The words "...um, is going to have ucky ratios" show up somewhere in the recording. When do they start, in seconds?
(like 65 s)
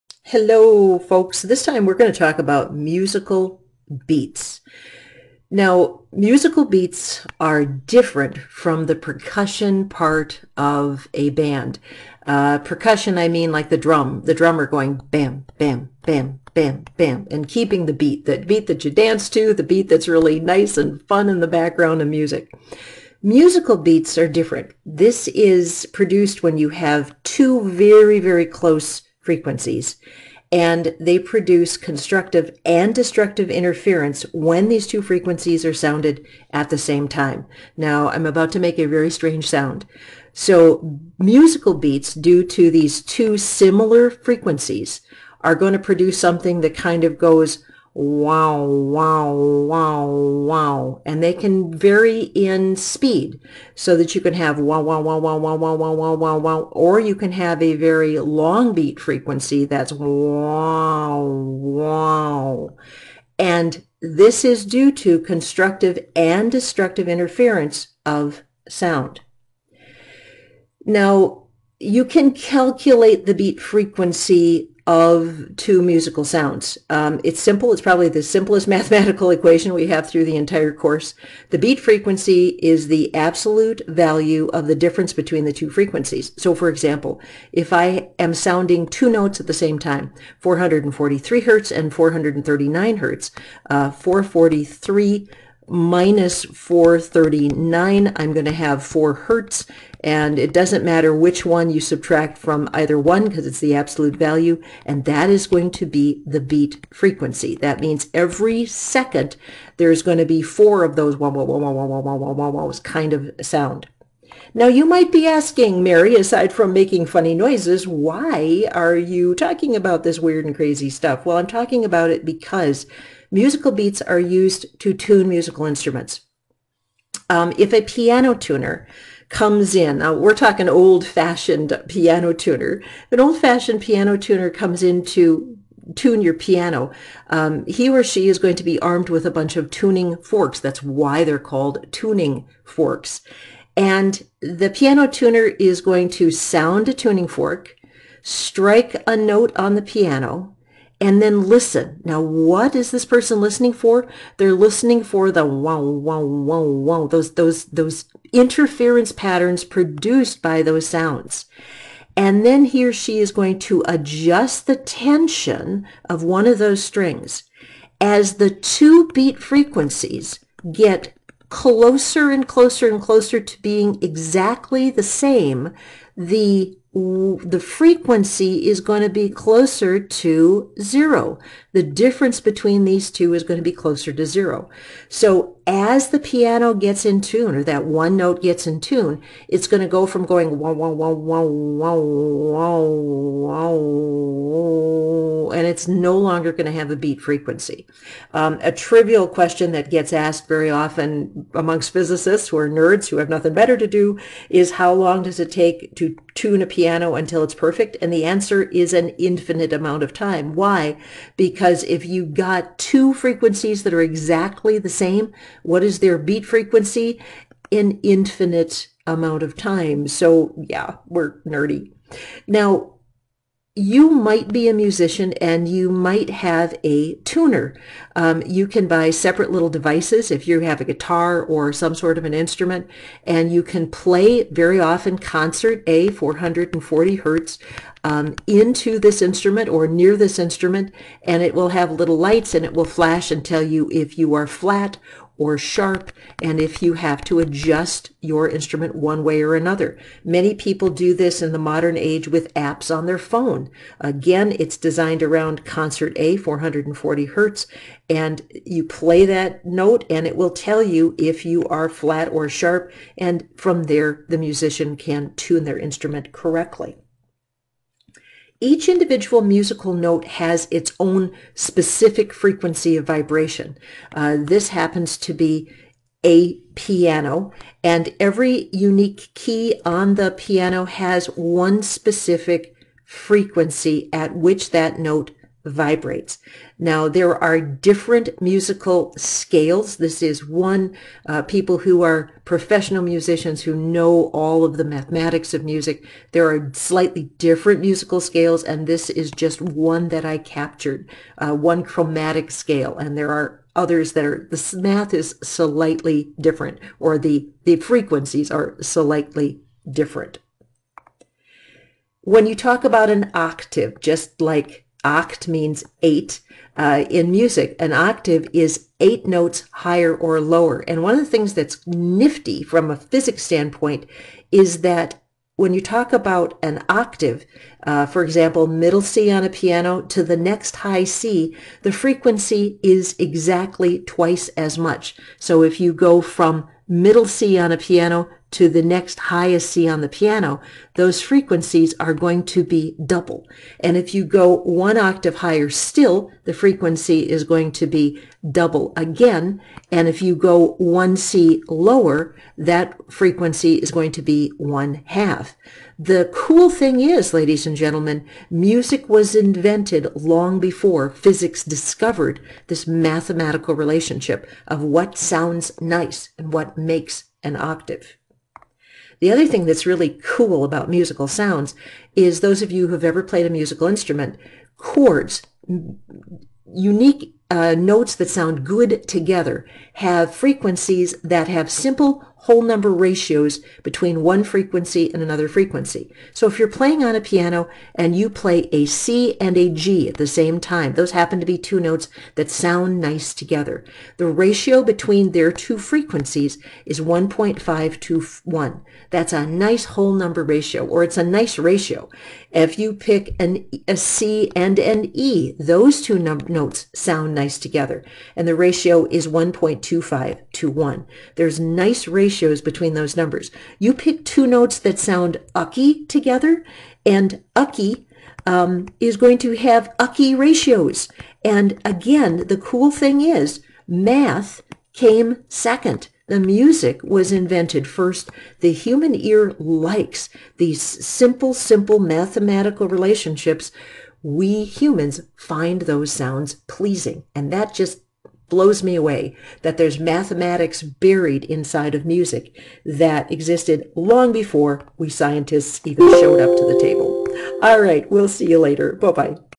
418 s.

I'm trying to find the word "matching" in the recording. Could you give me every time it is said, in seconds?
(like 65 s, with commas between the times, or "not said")
not said.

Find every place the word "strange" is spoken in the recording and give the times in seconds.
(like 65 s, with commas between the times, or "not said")
39 s.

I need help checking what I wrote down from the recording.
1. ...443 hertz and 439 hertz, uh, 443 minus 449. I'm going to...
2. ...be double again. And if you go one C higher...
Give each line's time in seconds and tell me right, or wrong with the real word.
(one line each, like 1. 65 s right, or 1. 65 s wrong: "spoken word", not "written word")
1. 90 s wrong: "439", not "449"
2. 347 s wrong: "lower", not "higher".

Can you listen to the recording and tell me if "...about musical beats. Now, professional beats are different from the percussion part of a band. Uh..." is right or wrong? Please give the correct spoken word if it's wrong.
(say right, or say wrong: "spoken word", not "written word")
wrong: "musical", not "professional".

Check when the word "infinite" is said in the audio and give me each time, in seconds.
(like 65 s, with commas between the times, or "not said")
209 s, 218 s.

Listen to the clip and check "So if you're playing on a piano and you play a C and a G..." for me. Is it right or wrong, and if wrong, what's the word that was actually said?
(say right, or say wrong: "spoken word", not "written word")
right.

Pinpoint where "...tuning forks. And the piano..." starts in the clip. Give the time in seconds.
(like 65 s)
141 s.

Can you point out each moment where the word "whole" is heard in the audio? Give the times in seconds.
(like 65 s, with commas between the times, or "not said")
382 s, 399 s.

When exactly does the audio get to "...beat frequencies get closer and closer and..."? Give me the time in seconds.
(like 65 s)
169 s.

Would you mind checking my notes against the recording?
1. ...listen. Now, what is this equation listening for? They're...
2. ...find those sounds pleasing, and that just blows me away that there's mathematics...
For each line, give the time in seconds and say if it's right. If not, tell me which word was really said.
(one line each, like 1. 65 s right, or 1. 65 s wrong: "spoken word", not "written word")
1. 151 s wrong: "person", not "equation"
2. 435 s right.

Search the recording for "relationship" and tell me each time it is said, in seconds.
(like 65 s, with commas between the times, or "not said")
363 s, 432 s.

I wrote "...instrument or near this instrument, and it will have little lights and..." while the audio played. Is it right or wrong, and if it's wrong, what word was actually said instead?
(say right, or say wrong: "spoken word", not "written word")
right.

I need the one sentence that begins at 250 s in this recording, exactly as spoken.
Many people do this in the modern age with apps on their phone.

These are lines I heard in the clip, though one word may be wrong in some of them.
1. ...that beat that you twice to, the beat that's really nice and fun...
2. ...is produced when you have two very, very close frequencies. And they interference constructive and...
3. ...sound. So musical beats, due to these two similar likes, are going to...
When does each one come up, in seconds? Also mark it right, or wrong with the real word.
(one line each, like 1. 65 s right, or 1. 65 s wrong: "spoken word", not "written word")
1. 18 s wrong: "dance", not "twice"
2. 25 s wrong: "produce", not "interference"
3. 39 s wrong: "frequencies", not "likes".